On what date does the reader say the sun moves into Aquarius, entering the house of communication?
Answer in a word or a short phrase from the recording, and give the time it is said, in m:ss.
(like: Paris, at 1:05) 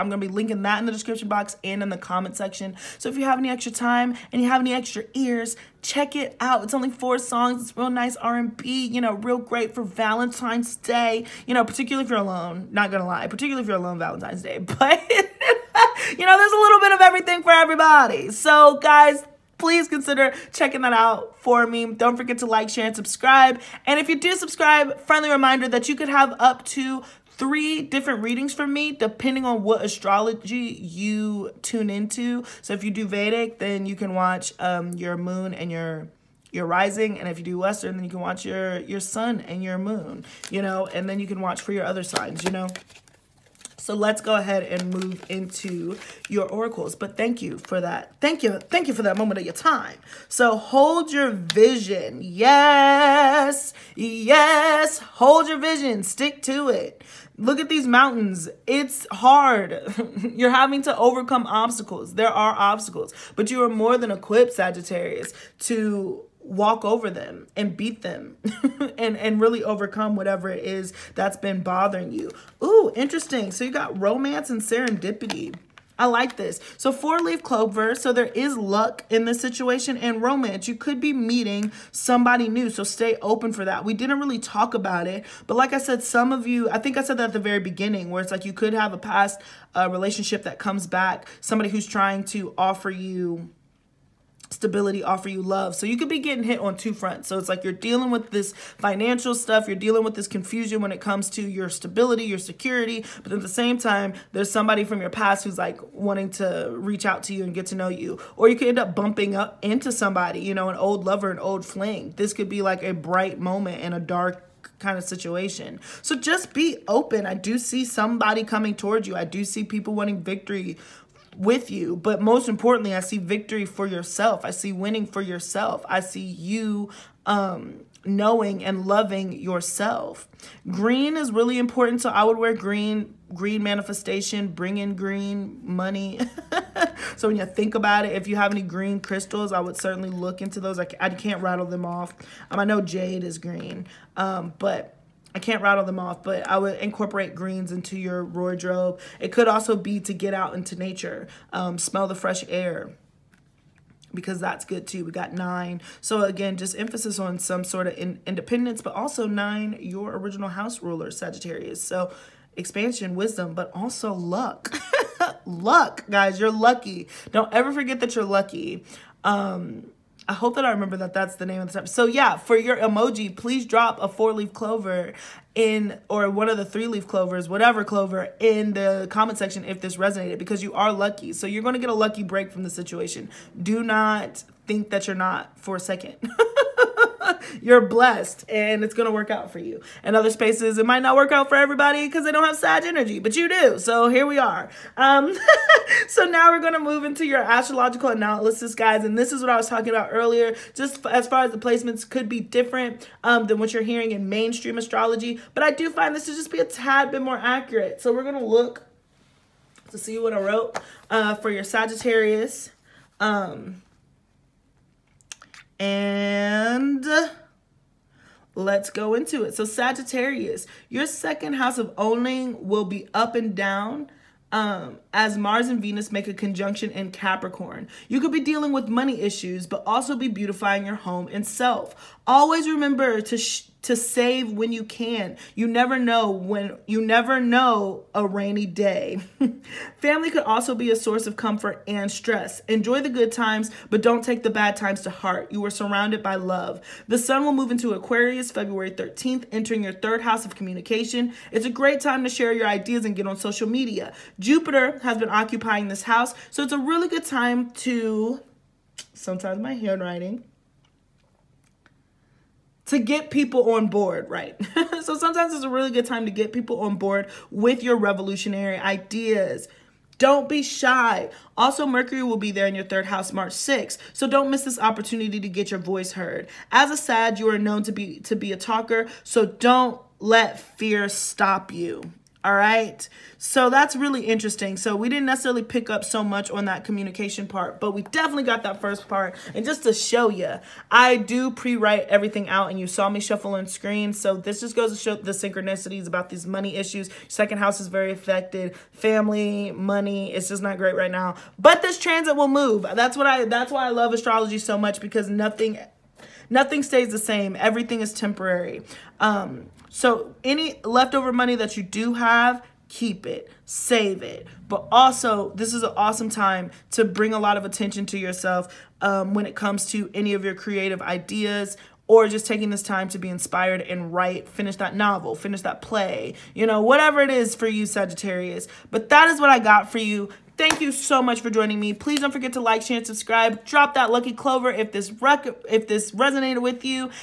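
February 13, at 4:08.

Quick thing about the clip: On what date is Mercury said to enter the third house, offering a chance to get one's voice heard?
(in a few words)
March 6.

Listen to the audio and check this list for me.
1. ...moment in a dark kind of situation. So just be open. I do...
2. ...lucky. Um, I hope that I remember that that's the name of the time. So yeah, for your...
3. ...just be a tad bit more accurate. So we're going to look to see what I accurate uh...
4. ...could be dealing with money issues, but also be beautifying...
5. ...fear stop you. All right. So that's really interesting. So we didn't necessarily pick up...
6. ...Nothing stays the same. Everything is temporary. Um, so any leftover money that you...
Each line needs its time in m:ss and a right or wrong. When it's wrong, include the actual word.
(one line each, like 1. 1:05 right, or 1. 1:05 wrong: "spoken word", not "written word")
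1. 1:53 right
2. 2:48 right
3. 3:26 wrong: "wrote", not "accurate"
4. 3:48 right
5. 4:40 right
6. 5:06 right.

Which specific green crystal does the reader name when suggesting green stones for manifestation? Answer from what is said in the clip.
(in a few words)
jade.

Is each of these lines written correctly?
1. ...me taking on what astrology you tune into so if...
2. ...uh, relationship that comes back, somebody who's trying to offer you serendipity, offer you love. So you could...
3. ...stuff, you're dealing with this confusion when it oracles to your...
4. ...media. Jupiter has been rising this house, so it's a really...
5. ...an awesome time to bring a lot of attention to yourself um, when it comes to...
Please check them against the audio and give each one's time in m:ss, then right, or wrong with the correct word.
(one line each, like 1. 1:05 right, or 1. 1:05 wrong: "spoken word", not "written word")
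1. 0:28 wrong: "depending", not "taking"
2. 1:29 wrong: "stability", not "serendipity"
3. 1:39 wrong: "comes", not "oracles"
4. 4:13 wrong: "occupying", not "rising"
5. 5:15 right.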